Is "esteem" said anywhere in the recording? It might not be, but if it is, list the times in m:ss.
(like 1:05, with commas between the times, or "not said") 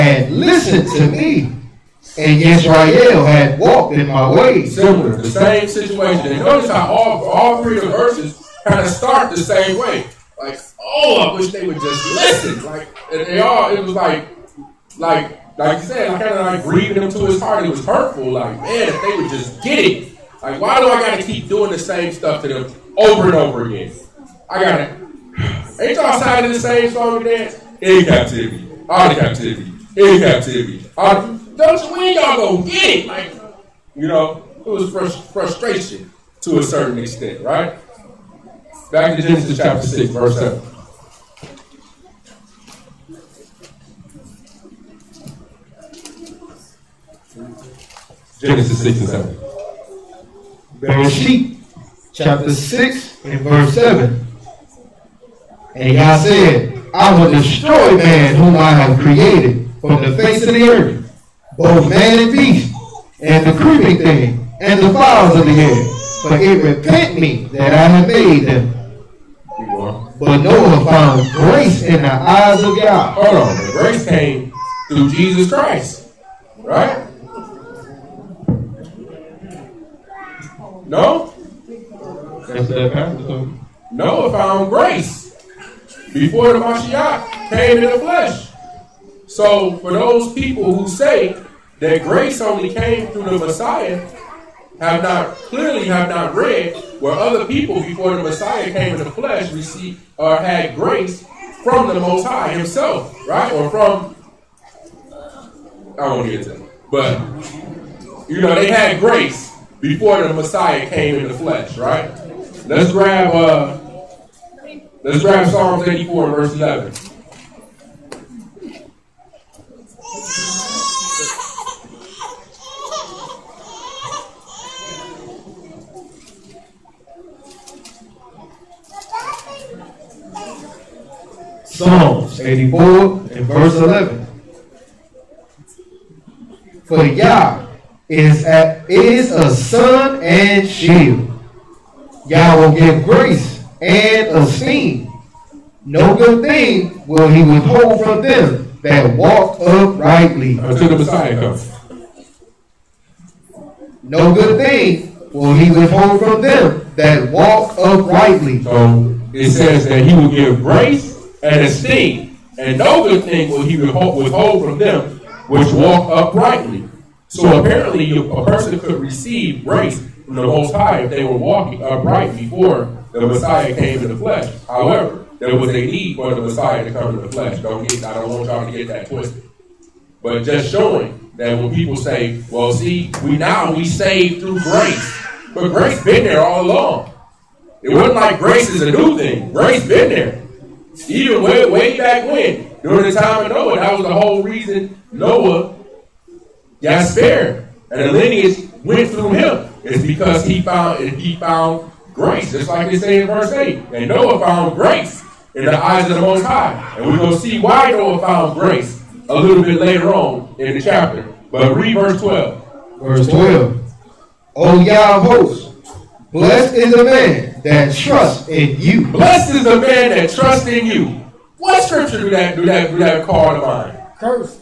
2:24, 2:41.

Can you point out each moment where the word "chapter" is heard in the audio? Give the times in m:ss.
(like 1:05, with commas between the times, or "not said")
0:39, 0:52, 3:30.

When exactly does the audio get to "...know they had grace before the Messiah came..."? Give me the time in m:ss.
1:48.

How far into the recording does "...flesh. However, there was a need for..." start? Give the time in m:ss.
2:54.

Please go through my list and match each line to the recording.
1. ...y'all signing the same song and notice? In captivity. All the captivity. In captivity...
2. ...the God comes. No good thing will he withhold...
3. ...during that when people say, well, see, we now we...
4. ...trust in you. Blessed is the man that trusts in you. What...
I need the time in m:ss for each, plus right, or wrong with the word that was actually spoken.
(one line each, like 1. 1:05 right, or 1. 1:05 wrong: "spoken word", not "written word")
1. 0:25 wrong: "dance", not "notice"
2. 2:30 wrong: "Messiah", not "God"
3. 3:00 wrong: "showing", not "during"
4. 3:37 right.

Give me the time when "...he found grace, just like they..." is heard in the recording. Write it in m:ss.
3:21.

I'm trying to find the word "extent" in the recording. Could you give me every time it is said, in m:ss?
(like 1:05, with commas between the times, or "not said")
0:36.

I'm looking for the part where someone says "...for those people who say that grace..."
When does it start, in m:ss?
1:29.